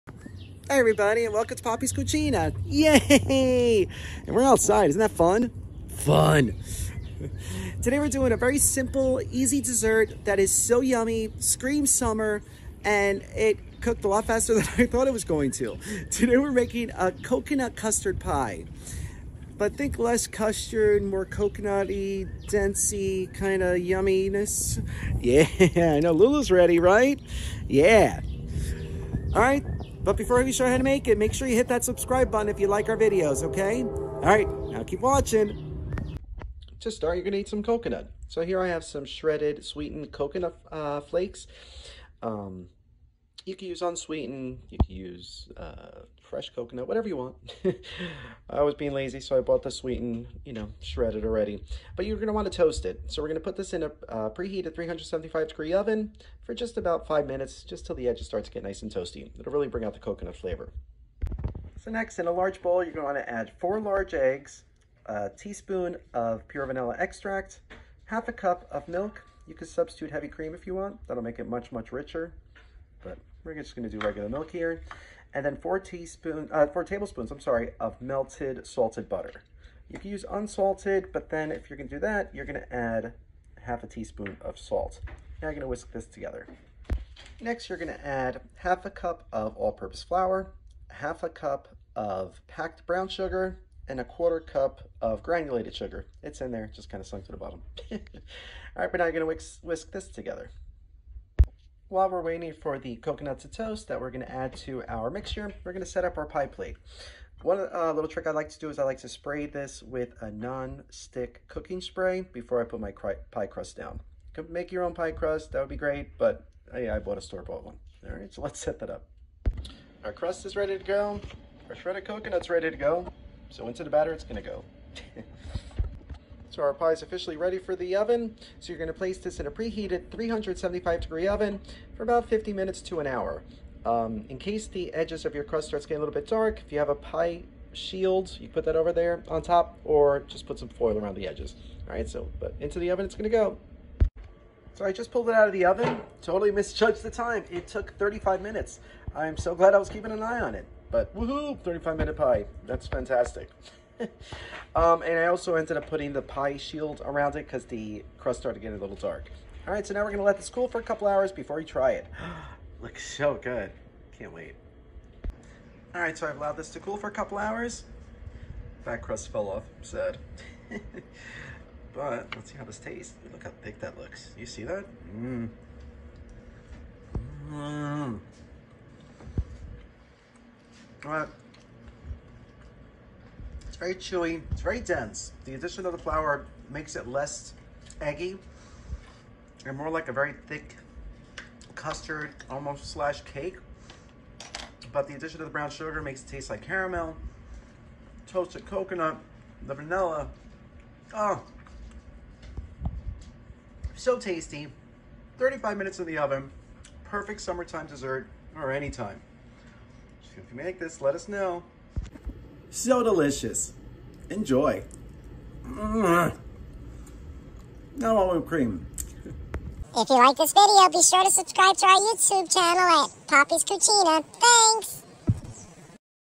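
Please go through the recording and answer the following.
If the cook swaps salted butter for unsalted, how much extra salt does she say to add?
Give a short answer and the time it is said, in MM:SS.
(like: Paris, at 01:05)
half a teaspoon, at 01:23.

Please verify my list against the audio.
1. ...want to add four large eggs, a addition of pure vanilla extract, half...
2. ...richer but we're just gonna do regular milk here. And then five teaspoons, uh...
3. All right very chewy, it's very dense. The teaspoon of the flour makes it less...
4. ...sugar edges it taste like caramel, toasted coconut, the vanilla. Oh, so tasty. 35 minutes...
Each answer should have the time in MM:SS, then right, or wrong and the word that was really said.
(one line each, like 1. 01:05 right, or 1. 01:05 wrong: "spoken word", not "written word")
1. 01:03 wrong: "teaspoon", not "addition"
2. 01:11 wrong: "four", not "five"
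3. 03:01 wrong: "addition", not "teaspoon"
4. 03:15 wrong: "makes", not "edges".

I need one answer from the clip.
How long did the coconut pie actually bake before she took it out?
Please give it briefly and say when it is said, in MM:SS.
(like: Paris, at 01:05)
35 minutes, at 02:27.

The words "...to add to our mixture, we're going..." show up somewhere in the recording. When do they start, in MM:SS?
01:44.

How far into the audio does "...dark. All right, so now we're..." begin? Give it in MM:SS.
02:38.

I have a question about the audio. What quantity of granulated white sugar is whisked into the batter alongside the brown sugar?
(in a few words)
a quarter cup.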